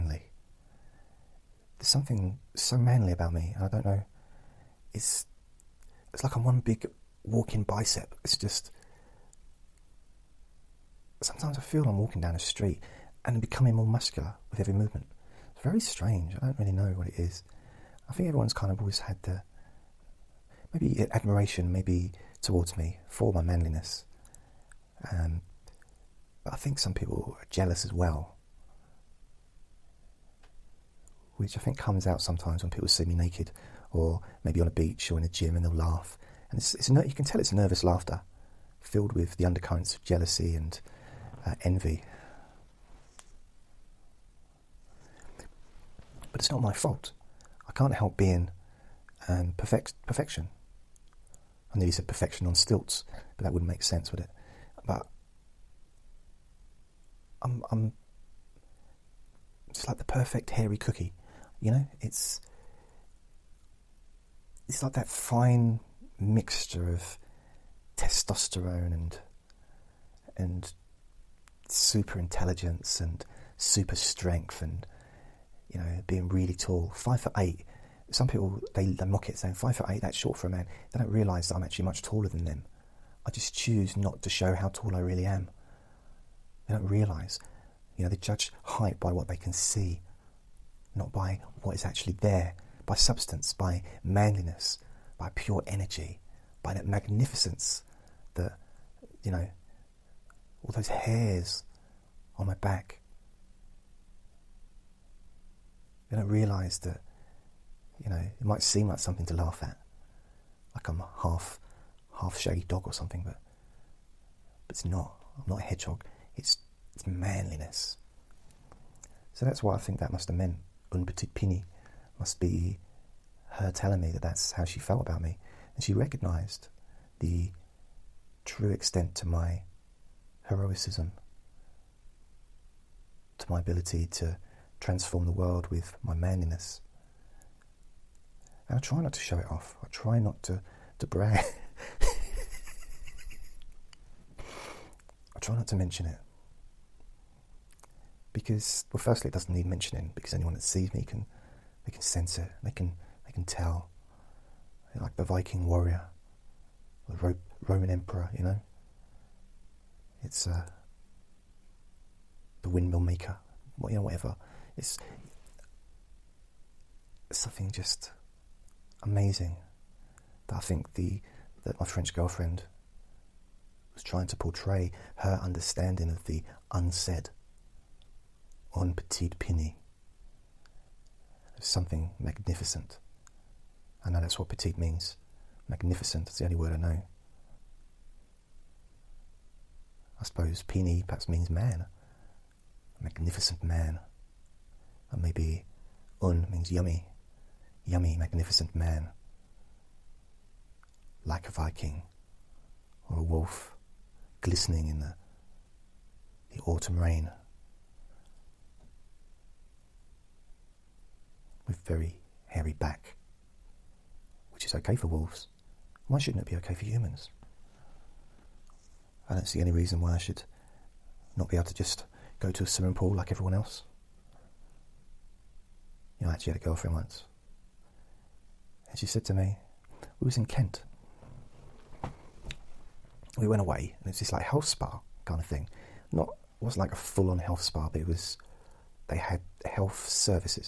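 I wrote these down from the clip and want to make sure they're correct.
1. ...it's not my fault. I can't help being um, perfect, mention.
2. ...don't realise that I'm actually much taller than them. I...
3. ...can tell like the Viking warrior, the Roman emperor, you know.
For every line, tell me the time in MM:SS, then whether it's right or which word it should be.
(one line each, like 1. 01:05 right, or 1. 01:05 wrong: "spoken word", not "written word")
1. 00:46 wrong: "perfection", not "mention"
2. 01:20 right
3. 02:33 right.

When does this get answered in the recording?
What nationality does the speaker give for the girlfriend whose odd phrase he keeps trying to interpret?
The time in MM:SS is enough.
02:51.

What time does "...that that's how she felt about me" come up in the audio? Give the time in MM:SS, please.
02:04.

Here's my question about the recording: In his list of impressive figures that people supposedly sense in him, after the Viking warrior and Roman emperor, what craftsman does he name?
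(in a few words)
windmill maker.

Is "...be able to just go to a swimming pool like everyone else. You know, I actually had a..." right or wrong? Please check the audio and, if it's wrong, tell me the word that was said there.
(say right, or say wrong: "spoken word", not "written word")
right.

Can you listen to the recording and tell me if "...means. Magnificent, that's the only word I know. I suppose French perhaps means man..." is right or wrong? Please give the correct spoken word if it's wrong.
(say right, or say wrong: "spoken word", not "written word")
wrong: "Pini", not "French".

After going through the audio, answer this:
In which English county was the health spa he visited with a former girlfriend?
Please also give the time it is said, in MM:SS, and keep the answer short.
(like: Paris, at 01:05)
Kent, at 03:50.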